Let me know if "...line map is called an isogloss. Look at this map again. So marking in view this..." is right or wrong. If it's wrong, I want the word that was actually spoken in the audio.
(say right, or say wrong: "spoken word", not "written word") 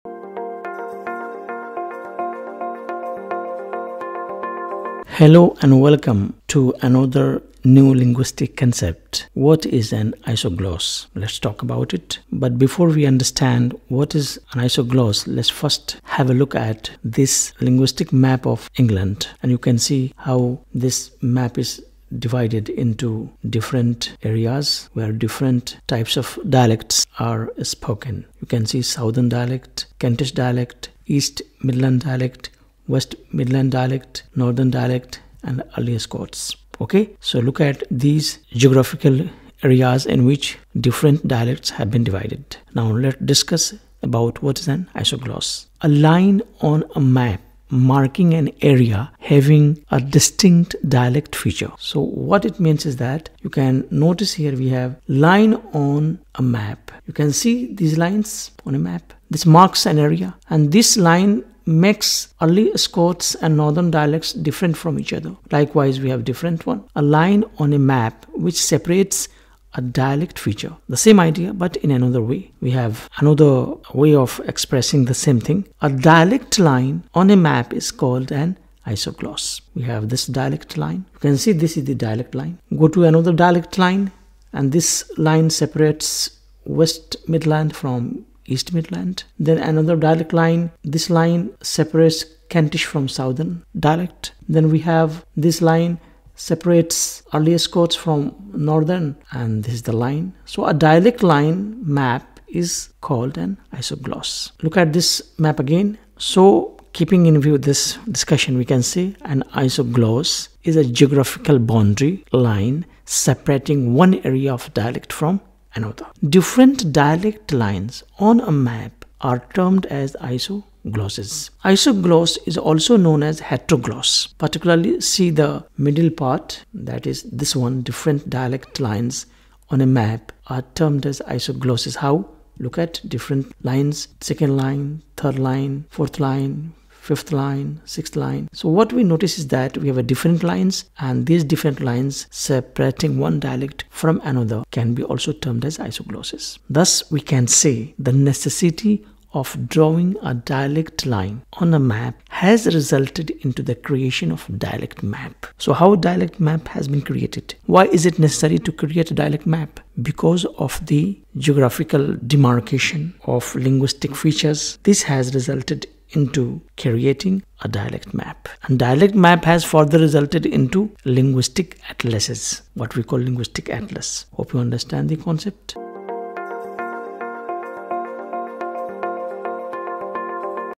wrong: "keeping", not "marking".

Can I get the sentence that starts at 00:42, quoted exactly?
Now let's discuss about what is an isogloss.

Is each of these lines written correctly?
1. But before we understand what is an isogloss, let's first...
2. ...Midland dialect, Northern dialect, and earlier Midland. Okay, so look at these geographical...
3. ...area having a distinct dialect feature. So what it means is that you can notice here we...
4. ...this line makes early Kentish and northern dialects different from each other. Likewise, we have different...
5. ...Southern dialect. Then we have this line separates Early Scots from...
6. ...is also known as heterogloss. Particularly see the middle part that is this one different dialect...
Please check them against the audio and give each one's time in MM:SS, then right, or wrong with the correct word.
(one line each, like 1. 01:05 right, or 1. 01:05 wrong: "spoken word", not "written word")
1. 00:12 right
2. 00:33 wrong: "Scots", not "Midland"
3. 00:48 right
4. 01:00 wrong: "Scots", not "Kentish"
5. 01:33 right
6. 02:02 right.